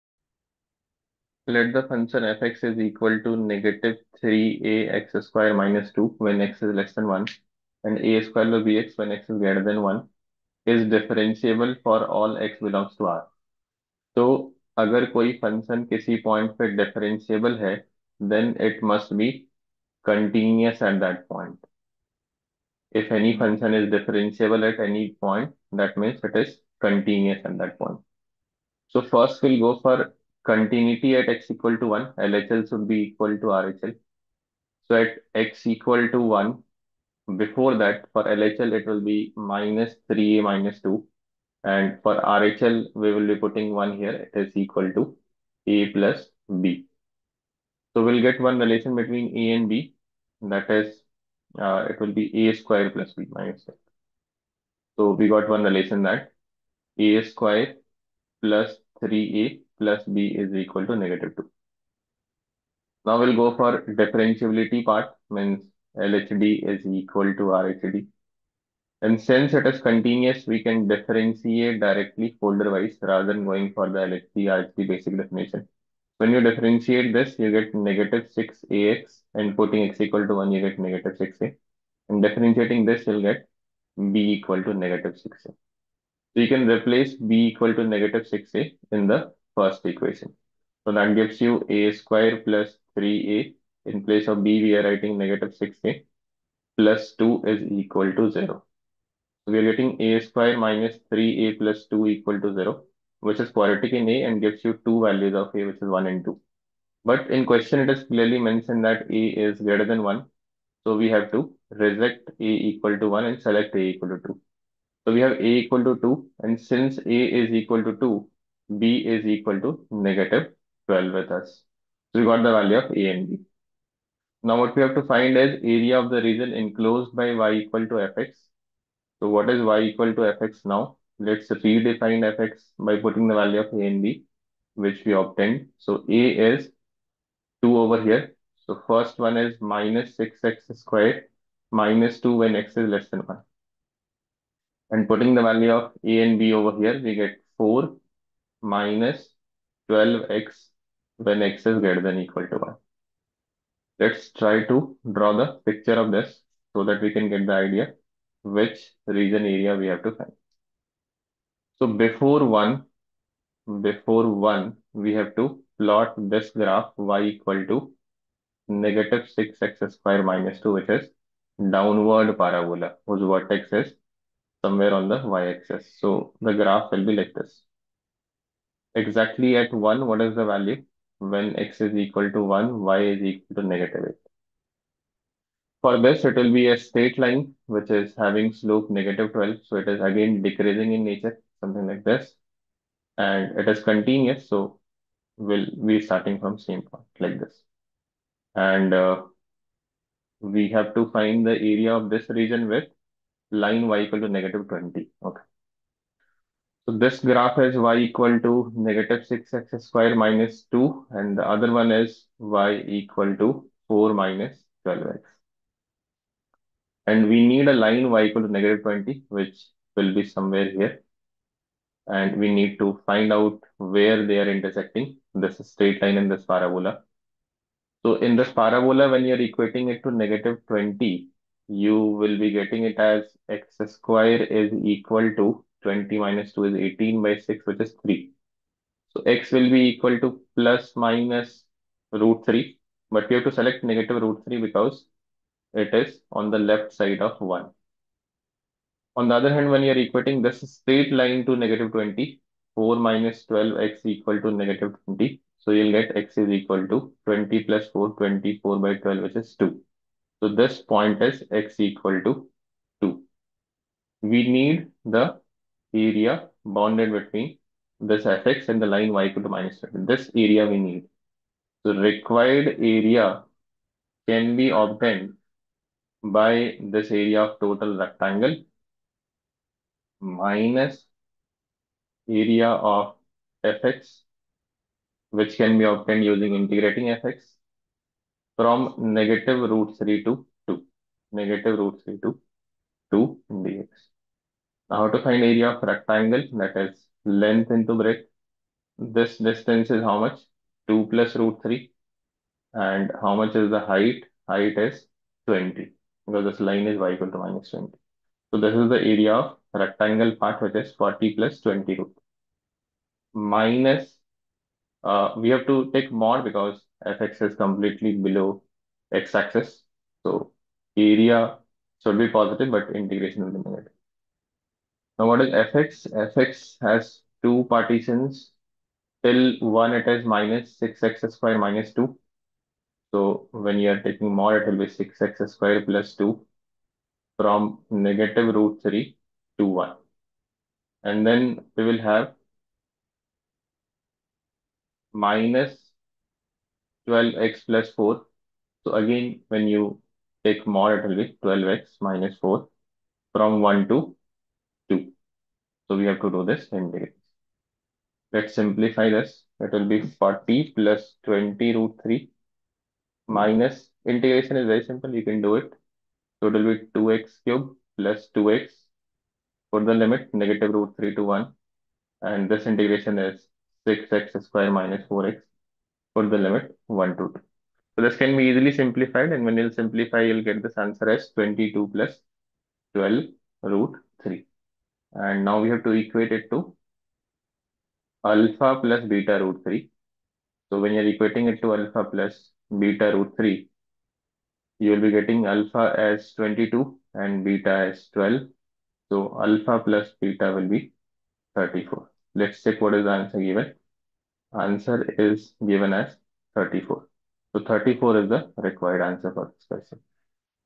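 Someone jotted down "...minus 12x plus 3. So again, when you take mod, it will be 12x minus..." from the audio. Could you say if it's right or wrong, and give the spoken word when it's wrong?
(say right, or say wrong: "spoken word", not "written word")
wrong: "4", not "3".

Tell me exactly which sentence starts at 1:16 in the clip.
When you differentiate this, you get negative 6AX and putting x equal to 1, you get negative 6A.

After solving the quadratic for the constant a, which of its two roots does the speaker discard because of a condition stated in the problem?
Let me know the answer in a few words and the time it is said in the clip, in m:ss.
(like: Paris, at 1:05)
1, at 1:51.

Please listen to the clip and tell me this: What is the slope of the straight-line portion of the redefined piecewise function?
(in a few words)
-12.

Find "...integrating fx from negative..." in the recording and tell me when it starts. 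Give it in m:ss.
4:46.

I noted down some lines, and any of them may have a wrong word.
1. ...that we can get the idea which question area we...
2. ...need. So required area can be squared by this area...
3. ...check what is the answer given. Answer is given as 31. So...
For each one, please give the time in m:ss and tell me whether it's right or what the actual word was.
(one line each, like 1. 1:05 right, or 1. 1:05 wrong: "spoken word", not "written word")
1. 2:36 wrong: "region", not "question"
2. 4:30 wrong: "obtained", not "squared"
3. 6:42 wrong: "34", not "31".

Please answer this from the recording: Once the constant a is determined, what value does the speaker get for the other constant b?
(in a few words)
-12.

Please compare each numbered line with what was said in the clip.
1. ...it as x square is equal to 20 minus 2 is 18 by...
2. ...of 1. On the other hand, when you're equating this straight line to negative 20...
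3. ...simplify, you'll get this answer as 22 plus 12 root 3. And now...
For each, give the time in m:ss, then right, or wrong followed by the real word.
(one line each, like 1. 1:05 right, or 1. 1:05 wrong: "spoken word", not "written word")
1. 3:52 right
2. 4:07 right
3. 6:19 right.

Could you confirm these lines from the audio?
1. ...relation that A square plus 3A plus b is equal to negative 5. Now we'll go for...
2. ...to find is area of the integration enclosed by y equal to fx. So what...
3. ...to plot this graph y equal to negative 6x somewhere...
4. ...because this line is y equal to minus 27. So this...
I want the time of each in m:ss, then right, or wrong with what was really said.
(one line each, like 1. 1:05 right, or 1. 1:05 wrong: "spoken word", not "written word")
1. 0:55 wrong: "2", not "5"
2. 2:04 wrong: "region", not "integration"
3. 2:45 wrong: "square", not "somewhere"
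4. 5:06 wrong: "20", not "27".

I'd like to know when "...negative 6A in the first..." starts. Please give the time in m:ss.
1:27.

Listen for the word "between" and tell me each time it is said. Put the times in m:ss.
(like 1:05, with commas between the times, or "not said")
0:48, 4:27.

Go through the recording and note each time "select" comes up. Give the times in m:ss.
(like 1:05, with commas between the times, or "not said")
1:53, 4:03.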